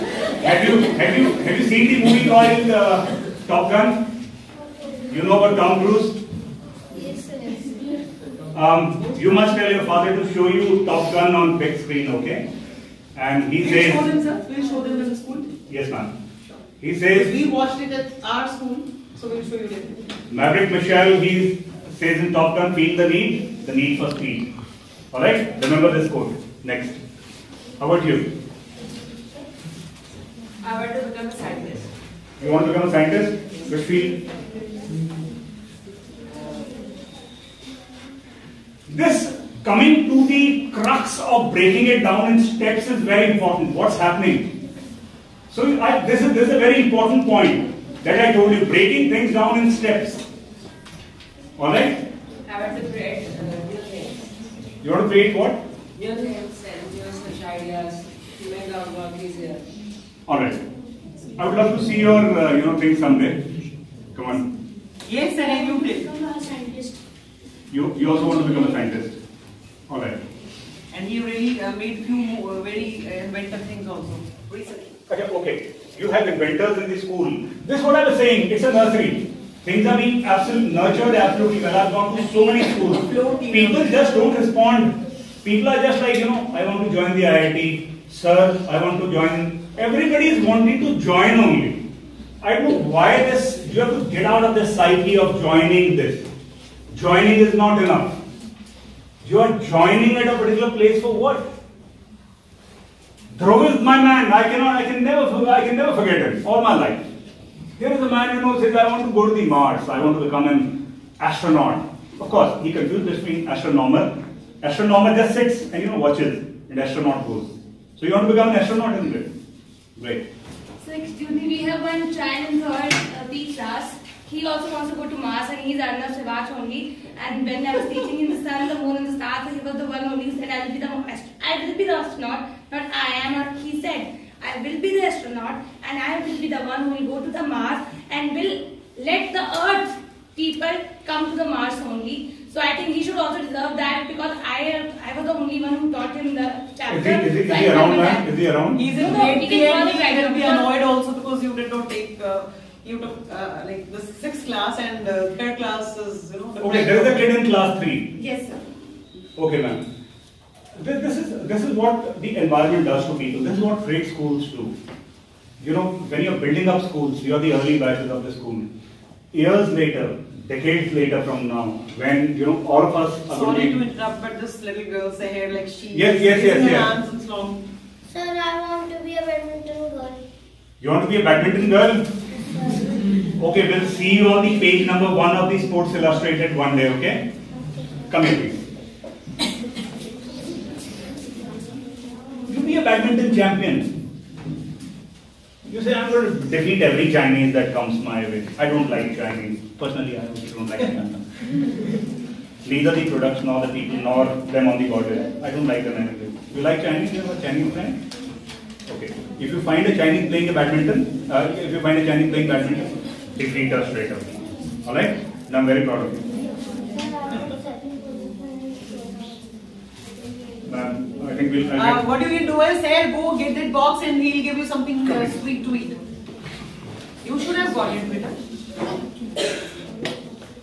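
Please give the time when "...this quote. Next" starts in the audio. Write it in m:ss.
0:25.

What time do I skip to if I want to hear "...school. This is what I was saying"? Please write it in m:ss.
1:17.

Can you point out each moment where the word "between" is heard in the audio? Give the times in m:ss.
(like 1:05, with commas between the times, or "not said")
1:53.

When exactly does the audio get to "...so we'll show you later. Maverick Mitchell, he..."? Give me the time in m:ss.
0:19.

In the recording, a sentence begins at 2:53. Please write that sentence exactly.
Are Sorry to interrupt, but this little girl's hair, like she.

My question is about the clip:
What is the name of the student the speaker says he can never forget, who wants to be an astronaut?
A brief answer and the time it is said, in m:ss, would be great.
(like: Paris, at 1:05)
Dhruv, at 1:43.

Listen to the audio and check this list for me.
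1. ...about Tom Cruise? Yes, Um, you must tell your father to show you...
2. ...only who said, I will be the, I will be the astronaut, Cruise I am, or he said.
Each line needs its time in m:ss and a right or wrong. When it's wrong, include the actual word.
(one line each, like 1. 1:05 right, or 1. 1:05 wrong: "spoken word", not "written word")
1. 0:05 right
2. 2:10 wrong: "But", not "Cruise".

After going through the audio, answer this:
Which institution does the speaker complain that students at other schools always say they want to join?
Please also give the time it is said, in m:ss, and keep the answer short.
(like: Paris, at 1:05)
IIT, at 1:27.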